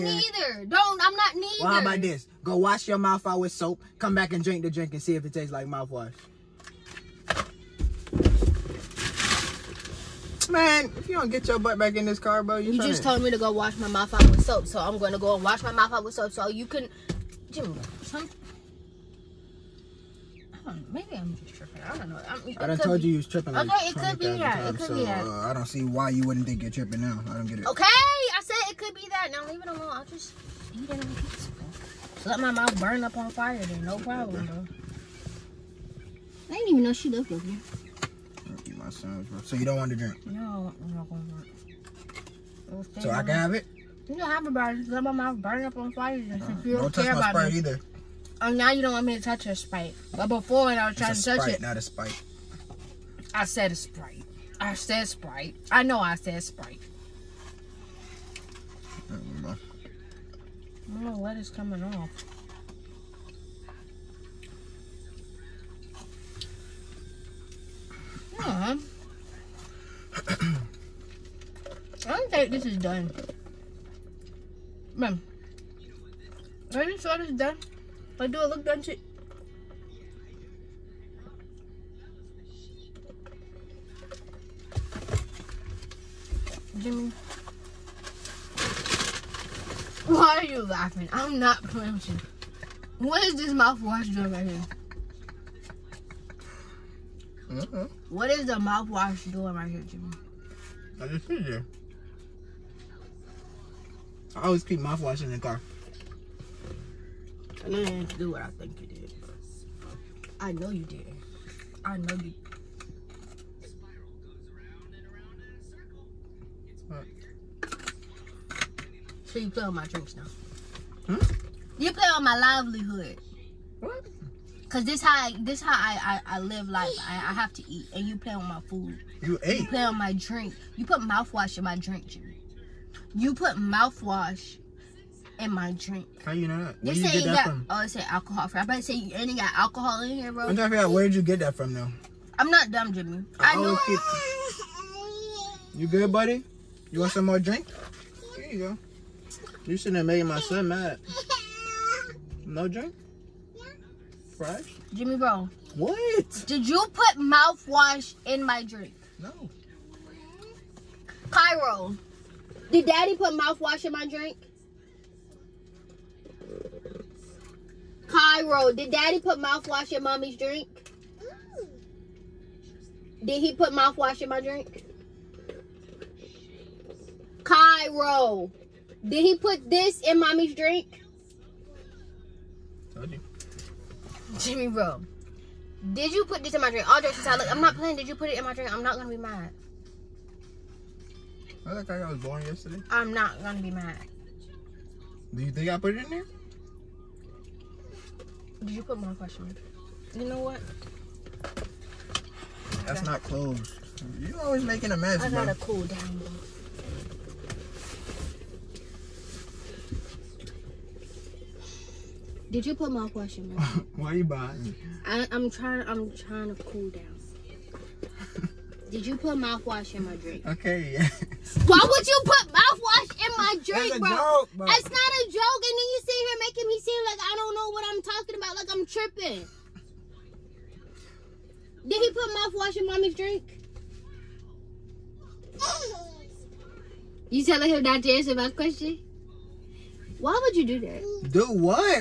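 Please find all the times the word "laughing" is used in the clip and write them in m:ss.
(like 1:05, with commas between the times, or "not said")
1:30.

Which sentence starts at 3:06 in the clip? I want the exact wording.
All dressed aside, look, I'm not playing.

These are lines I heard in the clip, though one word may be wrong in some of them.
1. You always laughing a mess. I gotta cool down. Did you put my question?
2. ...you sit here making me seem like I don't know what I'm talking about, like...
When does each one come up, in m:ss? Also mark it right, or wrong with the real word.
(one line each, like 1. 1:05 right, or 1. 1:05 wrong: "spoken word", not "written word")
1. 3:24 wrong: "making", not "laughing"
2. 3:45 right.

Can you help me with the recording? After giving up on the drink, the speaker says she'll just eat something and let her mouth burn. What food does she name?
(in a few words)
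pizza.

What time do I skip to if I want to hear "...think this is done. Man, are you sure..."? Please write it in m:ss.
1:12.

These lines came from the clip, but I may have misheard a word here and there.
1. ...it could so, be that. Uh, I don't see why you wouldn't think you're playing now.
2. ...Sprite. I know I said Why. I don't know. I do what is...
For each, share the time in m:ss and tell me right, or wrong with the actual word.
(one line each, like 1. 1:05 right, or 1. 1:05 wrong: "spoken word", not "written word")
1. 0:24 wrong: "tripping", not "playing"
2. 0:55 wrong: "Sprite", not "Why".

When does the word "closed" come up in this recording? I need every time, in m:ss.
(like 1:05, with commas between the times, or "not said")
3:23.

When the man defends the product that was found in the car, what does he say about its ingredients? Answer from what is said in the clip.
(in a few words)
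alcohol free.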